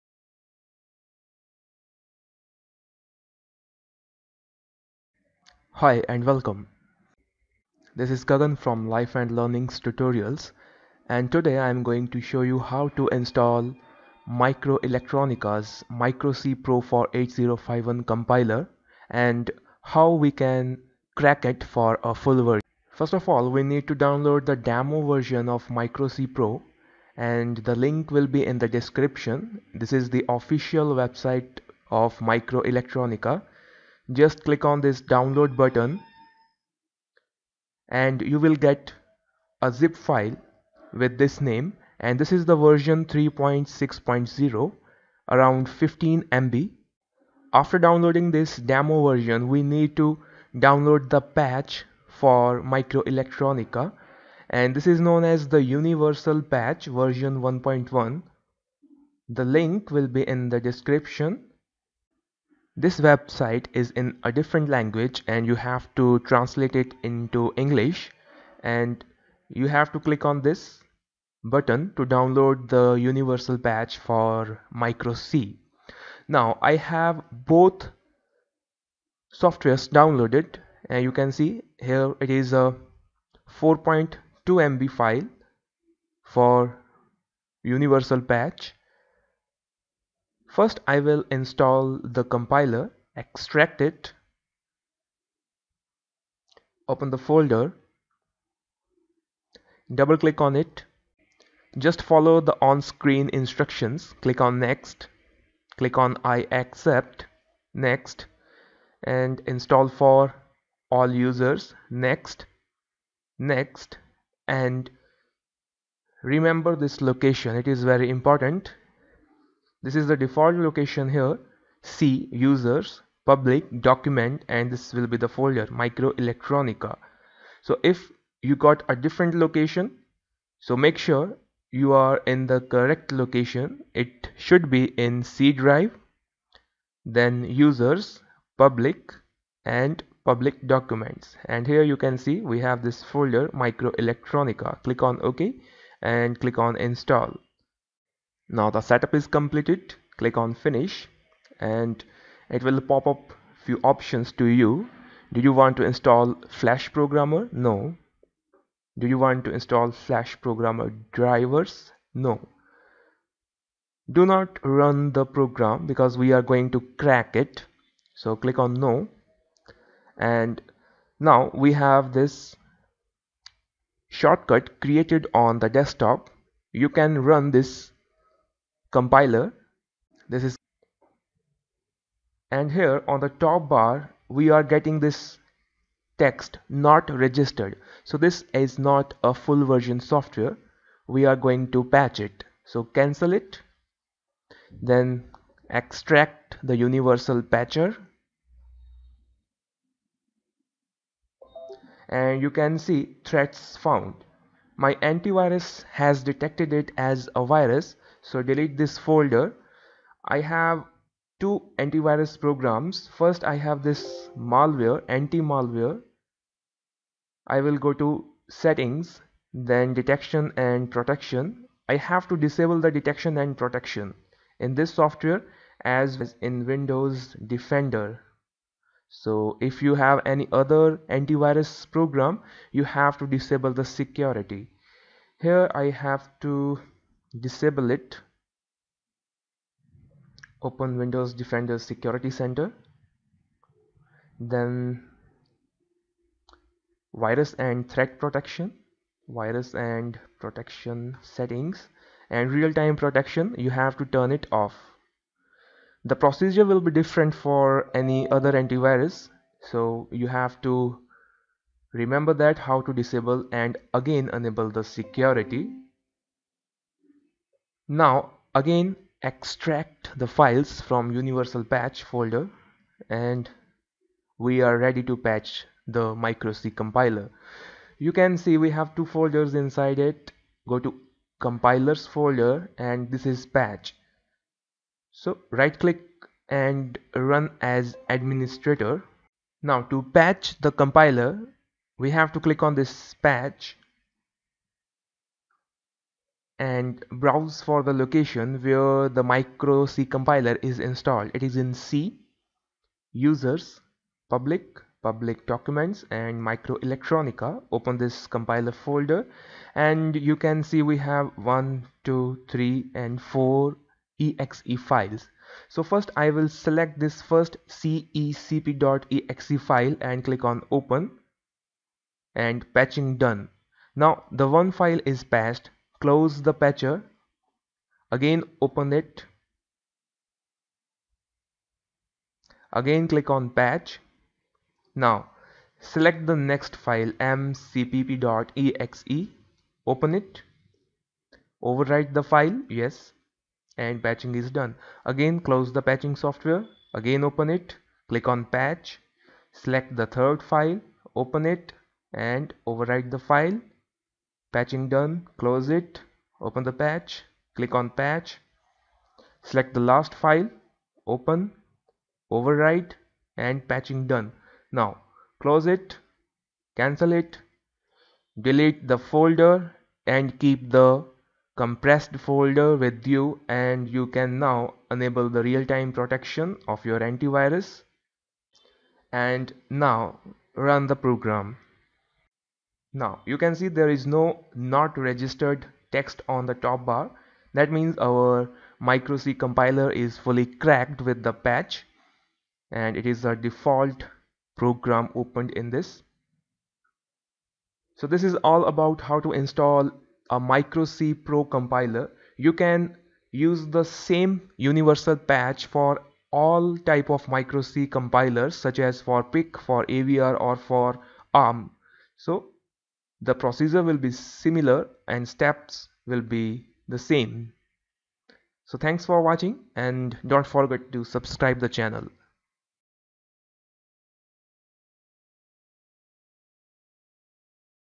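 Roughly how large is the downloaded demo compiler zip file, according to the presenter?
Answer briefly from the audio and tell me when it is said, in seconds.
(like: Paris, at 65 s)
15 MB, at 45 s.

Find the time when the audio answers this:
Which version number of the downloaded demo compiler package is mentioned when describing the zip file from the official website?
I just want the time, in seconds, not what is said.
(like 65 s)
43 s.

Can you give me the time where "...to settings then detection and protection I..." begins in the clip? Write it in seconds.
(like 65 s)
217 s.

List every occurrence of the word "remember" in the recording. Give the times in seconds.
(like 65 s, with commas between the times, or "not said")
116 s, 261 s.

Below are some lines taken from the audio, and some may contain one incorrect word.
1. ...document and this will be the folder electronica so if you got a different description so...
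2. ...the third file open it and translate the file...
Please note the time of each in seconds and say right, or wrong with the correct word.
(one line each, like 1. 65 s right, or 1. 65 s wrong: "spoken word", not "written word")
1. 123 s wrong: "location", not "description"
2. 350 s wrong: "overwrite", not "translate".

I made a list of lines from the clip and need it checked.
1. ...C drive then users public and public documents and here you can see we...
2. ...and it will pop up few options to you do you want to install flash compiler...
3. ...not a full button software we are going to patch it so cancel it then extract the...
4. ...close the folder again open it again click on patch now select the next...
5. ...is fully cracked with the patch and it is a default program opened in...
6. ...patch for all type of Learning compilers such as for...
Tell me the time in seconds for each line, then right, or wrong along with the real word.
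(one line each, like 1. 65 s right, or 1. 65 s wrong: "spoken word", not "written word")
1. 135 s right
2. 151 s wrong: "programmer", not "compiler"
3. 188 s wrong: "version", not "button"
4. 326 s wrong: "patcher", not "folder"
5. 389 s right
6. 405 s wrong: "MikroC", not "Learning".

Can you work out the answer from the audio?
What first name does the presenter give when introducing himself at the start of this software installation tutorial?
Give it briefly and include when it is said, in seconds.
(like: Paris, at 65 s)
Gagan, at 8 s.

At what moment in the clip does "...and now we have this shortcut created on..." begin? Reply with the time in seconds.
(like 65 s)
170 s.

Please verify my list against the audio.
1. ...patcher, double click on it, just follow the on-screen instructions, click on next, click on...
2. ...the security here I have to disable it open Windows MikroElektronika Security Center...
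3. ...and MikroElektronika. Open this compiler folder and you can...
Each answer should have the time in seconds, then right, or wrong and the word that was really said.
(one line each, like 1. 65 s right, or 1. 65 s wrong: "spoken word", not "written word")
1. 97 s wrong: "folder", not "patcher"
2. 233 s wrong: "Defender", not "MikroElektronika"
3. 306 s right.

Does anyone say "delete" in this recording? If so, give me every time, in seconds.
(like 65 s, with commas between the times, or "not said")
208 s, 368 s.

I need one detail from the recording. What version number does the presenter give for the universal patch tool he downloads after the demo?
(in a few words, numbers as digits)
1.1.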